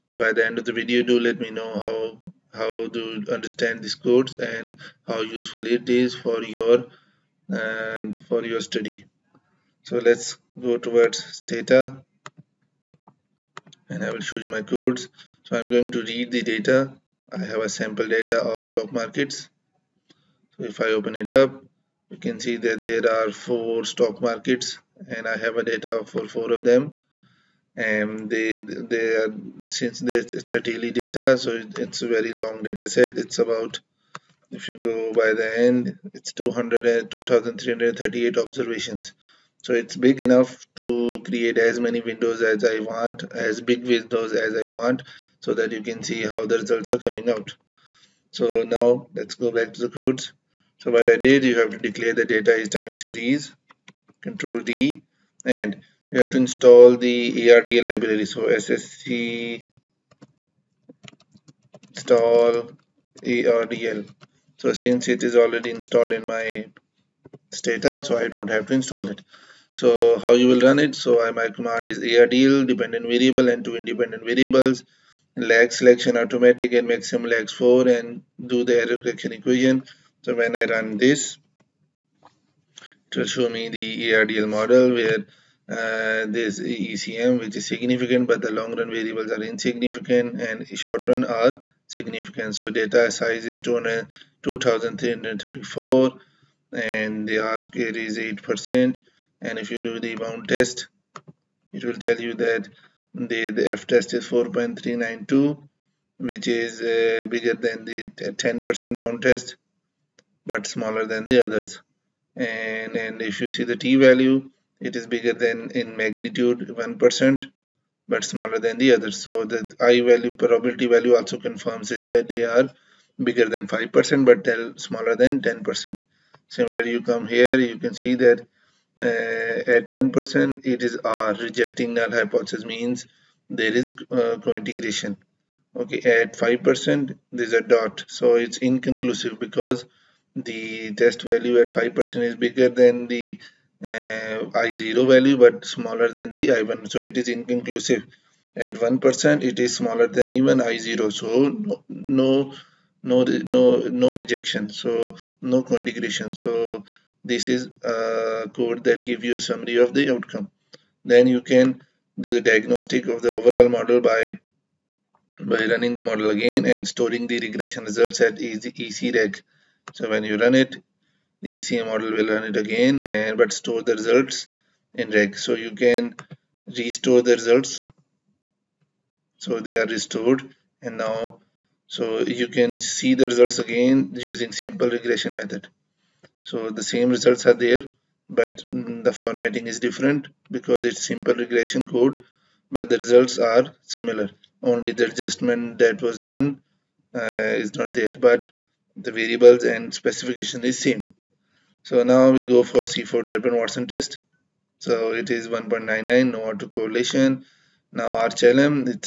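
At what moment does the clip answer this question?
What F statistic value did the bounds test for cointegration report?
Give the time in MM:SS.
01:44.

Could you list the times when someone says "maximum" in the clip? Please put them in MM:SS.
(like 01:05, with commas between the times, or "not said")
01:16.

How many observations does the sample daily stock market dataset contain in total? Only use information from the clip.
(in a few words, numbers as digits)
2338.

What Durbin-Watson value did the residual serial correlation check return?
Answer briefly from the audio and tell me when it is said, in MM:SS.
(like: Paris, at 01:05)
1.99, at 03:25.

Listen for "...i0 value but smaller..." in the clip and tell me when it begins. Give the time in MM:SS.
02:24.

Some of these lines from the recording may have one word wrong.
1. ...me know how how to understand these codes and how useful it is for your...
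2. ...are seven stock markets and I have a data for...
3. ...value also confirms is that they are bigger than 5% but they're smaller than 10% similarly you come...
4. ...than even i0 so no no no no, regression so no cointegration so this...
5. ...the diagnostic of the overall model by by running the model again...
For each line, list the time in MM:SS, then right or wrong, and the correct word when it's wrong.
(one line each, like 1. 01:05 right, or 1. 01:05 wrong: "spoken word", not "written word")
1. 00:01 right
2. 00:23 wrong: "four", not "seven"
3. 02:00 right
4. 02:30 wrong: "rejection", not "regression"
5. 02:42 right.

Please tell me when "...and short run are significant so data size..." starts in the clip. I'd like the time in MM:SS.
01:30.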